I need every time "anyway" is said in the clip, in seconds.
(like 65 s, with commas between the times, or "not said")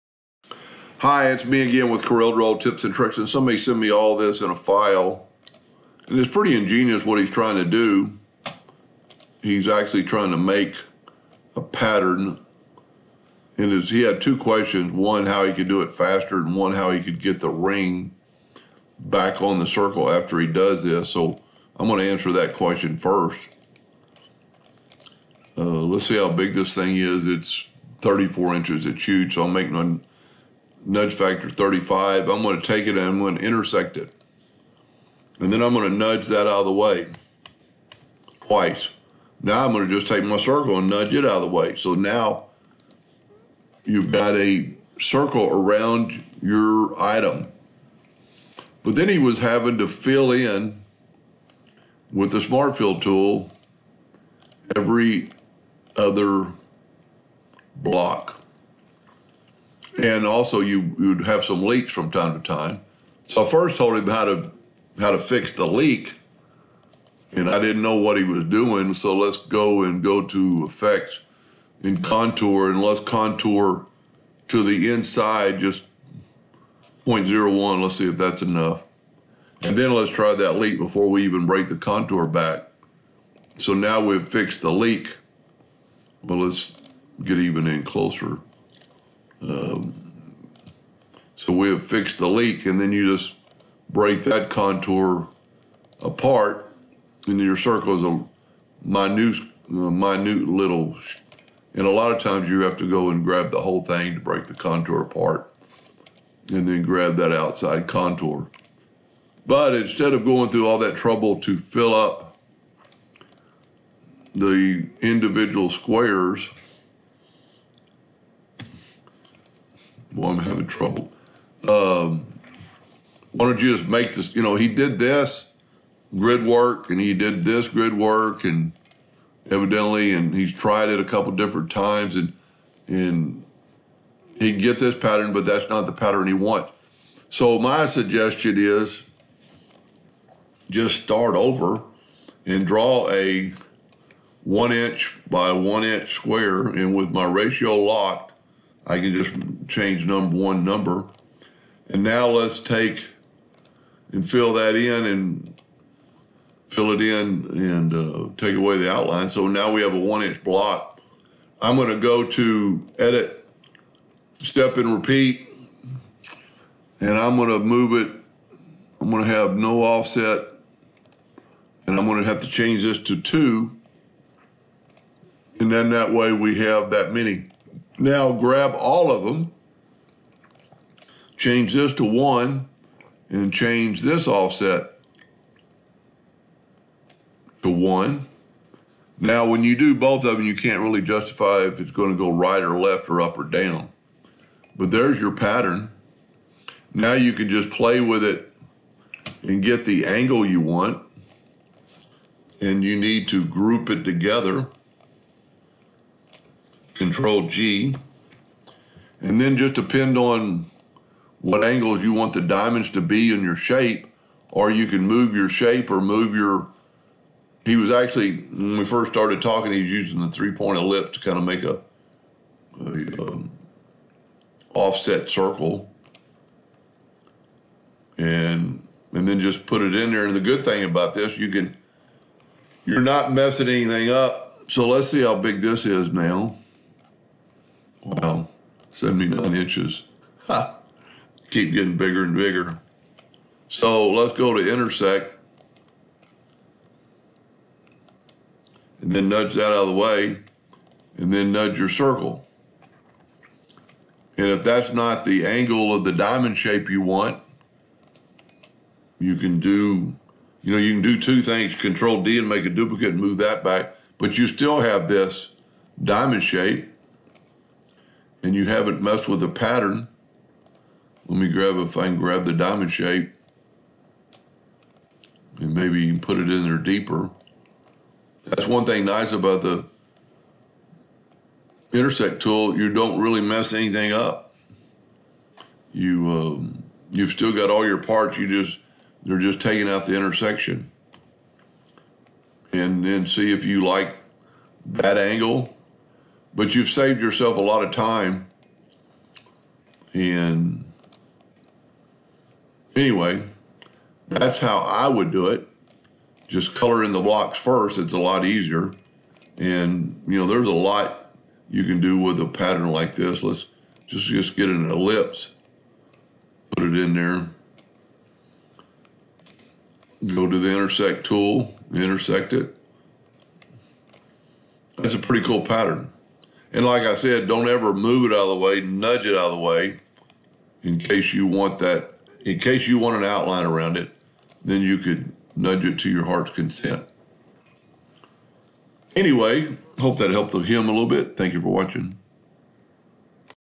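302 s, 339 s.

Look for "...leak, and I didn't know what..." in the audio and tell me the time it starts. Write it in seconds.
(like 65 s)
65 s.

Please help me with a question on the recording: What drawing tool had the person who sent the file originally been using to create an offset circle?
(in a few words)
three-point ellipse.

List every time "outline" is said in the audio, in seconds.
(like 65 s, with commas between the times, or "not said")
158 s, 333 s.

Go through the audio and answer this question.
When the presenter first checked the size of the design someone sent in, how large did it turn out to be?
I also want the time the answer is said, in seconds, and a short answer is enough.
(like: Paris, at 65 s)
34 inches, at 28 s.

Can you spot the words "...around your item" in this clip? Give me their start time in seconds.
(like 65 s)
45 s.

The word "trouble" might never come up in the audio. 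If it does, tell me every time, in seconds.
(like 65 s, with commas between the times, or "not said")
110 s, 120 s.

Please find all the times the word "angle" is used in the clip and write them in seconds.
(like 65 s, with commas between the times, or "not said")
200 s, 211 s, 255 s, 295 s.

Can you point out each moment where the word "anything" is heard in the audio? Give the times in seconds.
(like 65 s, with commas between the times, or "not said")
233 s, 283 s.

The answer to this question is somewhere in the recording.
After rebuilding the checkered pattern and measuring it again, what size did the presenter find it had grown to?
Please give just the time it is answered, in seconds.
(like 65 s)
238 s.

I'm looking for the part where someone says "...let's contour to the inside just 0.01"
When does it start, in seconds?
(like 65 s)
72 s.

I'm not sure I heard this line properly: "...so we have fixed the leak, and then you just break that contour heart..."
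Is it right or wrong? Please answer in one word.
wrong.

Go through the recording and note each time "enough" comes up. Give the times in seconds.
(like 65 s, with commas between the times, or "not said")
78 s.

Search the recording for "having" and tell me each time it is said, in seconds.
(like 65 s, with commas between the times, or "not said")
49 s, 120 s.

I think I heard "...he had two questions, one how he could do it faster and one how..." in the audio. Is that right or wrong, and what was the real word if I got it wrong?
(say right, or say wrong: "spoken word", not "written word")
right.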